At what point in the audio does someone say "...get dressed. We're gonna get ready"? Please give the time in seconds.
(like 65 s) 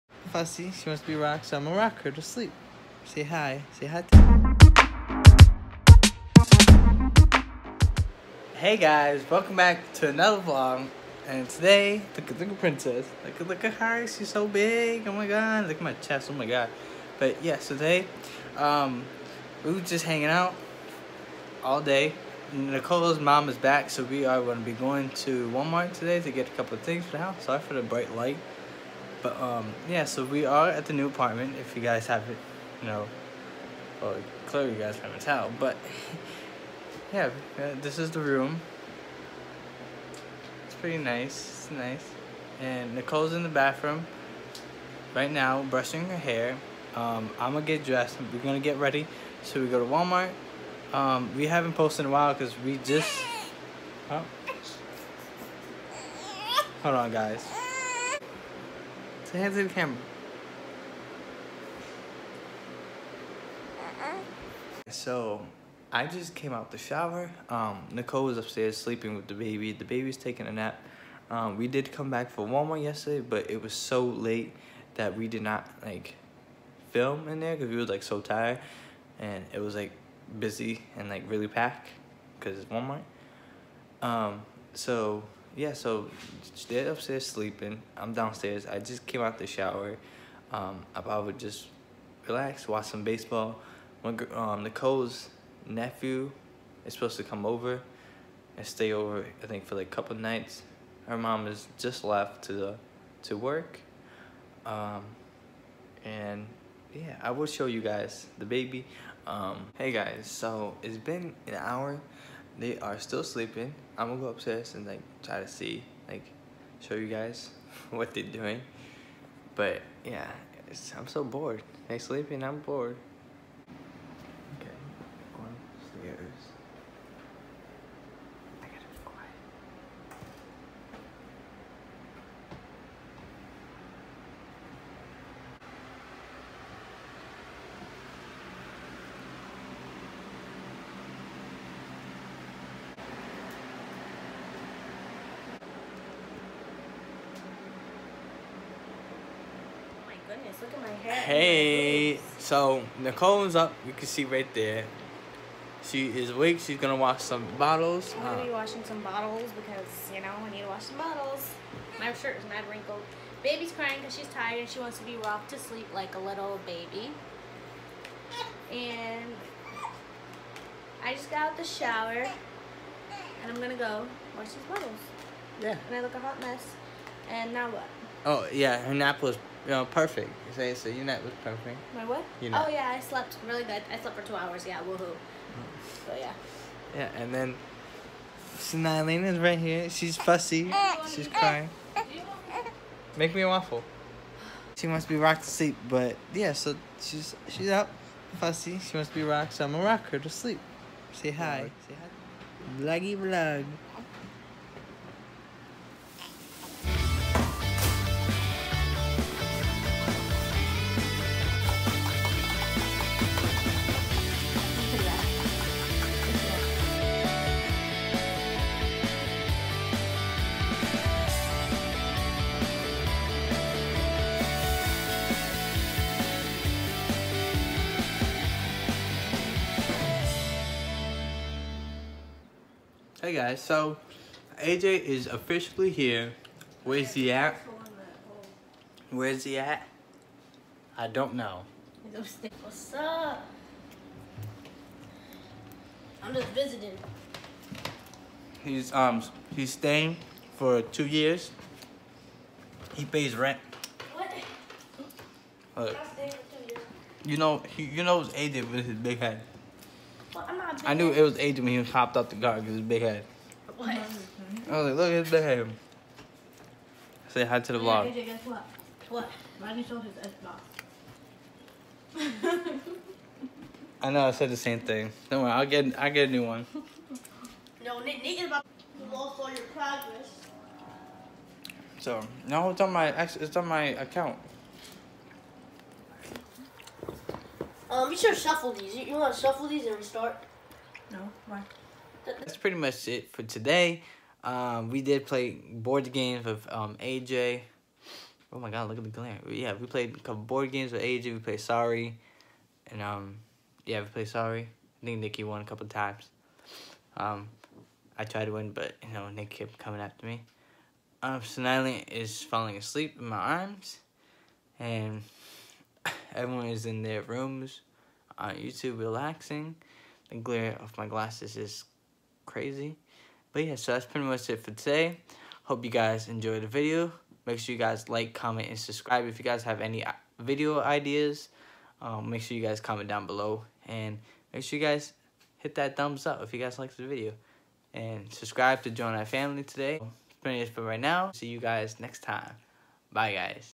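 47 s.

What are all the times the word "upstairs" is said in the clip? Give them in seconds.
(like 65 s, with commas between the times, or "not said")
68 s, 86 s, 114 s.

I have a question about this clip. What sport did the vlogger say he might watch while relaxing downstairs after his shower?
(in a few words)
Baseball.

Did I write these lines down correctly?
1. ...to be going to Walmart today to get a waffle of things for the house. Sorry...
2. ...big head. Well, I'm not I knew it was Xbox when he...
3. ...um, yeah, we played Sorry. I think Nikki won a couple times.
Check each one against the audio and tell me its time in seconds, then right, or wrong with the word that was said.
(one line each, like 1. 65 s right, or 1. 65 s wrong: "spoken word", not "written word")
1. 24 s wrong: "couple", not "waffle"
2. 258 s wrong: "Adrian", not "Xbox"
3. 303 s right.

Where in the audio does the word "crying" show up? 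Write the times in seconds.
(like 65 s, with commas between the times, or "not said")
163 s, 191 s.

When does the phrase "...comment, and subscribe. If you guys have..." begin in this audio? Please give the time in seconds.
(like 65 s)
328 s.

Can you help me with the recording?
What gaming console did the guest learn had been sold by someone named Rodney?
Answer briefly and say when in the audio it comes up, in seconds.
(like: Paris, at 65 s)
Xbox, at 270 s.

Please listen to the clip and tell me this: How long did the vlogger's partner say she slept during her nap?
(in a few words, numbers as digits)
2 hours.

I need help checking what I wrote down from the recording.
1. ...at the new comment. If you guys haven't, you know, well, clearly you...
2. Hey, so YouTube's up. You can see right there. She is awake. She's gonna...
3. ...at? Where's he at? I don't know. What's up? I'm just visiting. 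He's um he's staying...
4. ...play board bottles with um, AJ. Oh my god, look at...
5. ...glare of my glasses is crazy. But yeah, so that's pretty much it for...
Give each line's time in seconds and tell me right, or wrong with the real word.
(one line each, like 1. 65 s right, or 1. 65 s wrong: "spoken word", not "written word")
1. 30 s wrong: "apartment", not "comment"
2. 151 s wrong: "Nicole", not "YouTube"
3. 237 s right
4. 295 s wrong: "games", not "bottles"
5. 320 s right.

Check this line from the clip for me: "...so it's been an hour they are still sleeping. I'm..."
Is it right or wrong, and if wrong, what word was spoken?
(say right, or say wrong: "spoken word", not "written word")
right.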